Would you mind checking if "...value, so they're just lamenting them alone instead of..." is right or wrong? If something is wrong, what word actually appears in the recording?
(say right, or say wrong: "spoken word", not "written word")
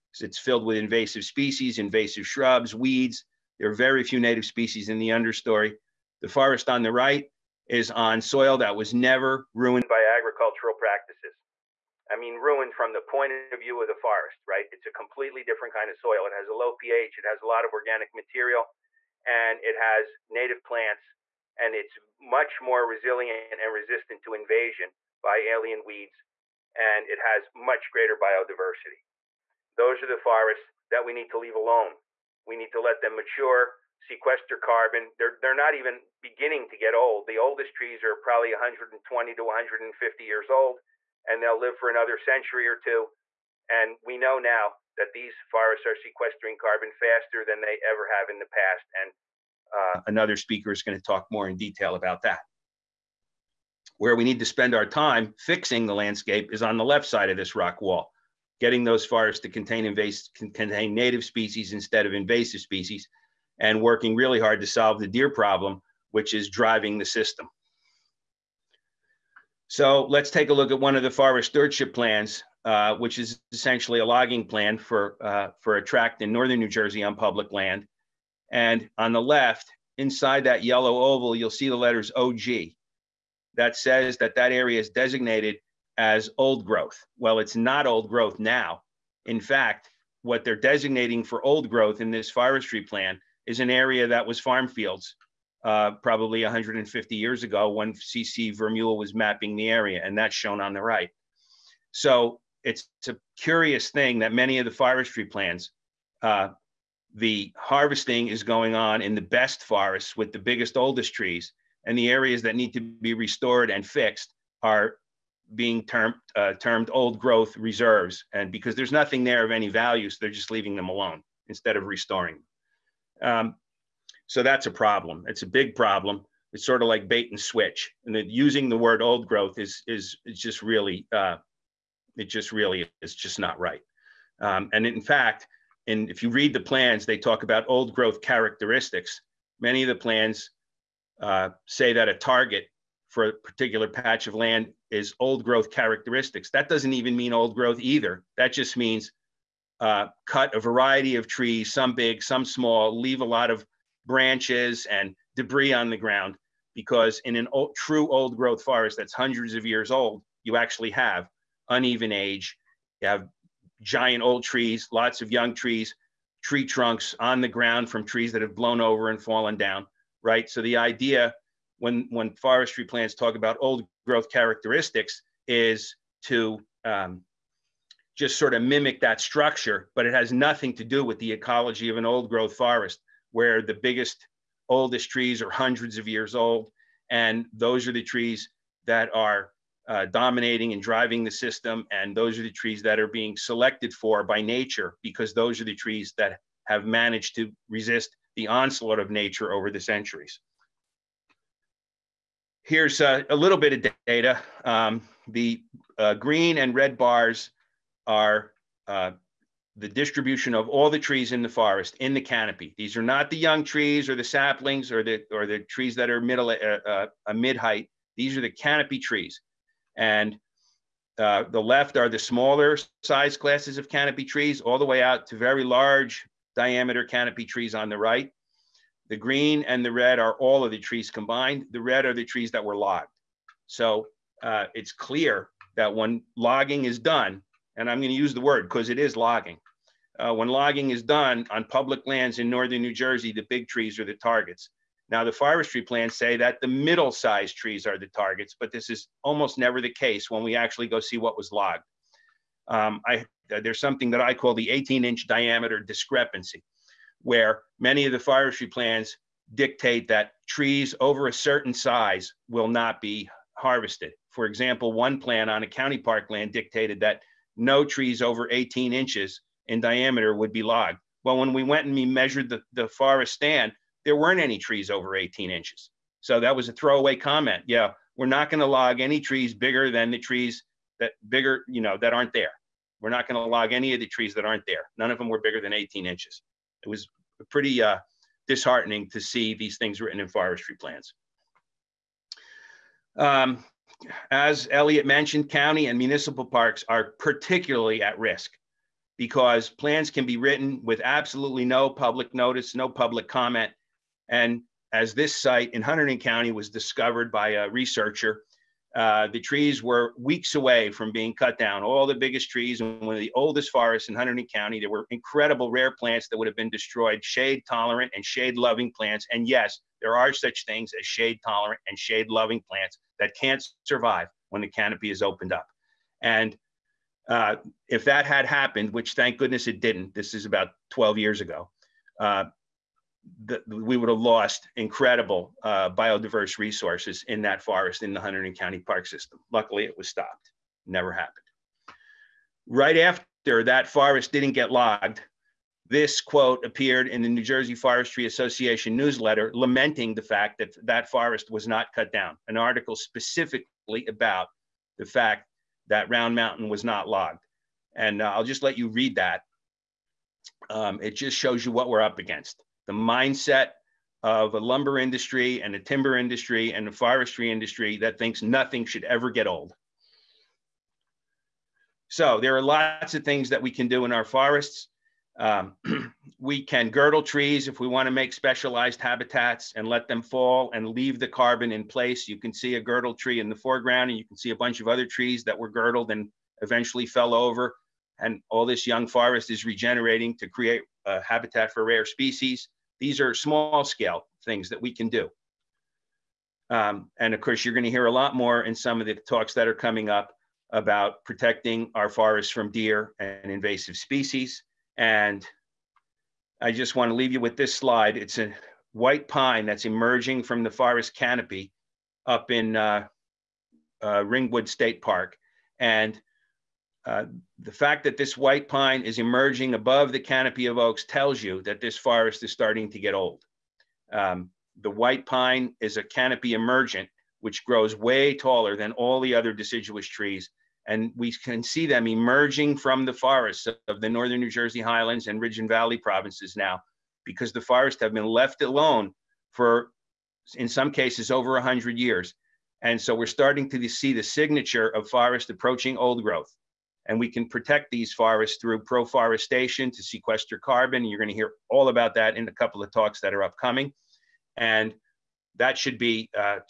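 wrong: "leaving", not "lamenting".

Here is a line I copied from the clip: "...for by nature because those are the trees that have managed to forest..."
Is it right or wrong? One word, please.
wrong.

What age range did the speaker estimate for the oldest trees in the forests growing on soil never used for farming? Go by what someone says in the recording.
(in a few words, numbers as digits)
120 to 150 years.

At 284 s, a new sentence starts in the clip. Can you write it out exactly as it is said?
None of them were bigger than 18 inches.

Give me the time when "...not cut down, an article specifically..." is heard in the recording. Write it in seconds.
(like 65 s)
351 s.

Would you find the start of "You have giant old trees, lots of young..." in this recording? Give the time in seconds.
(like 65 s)
162 s.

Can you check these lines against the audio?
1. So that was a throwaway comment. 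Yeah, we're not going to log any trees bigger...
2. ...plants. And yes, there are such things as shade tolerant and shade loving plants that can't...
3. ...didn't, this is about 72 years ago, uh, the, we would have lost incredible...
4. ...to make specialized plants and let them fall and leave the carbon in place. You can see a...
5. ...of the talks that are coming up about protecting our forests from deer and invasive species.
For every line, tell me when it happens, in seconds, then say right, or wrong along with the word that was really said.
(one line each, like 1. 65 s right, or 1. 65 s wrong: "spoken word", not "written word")
1. 276 s right
2. 318 s right
3. 329 s wrong: "12", not "72"
4. 378 s wrong: "habitats", not "plants"
5. 398 s right.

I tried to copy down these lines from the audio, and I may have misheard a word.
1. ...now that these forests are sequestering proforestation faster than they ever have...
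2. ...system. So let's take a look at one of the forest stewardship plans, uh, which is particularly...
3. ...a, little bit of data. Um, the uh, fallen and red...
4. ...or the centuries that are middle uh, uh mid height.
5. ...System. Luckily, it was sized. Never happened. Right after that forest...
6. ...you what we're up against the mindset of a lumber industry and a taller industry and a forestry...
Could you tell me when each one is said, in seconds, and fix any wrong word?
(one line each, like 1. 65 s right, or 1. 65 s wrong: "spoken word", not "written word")
1. 44 s wrong: "carbon", not "proforestation"
2. 67 s wrong: "essentially", not "particularly"
3. 203 s wrong: "green", not "fallen"
4. 215 s wrong: "trees", not "centuries"
5. 339 s wrong: "stopped", not "sized"
6. 361 s wrong: "timber", not "taller".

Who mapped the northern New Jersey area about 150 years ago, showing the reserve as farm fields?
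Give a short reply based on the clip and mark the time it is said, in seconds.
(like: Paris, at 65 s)
CC Vermeule, at 97 s.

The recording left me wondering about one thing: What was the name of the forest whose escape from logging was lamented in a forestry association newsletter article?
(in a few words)
Round Mountain.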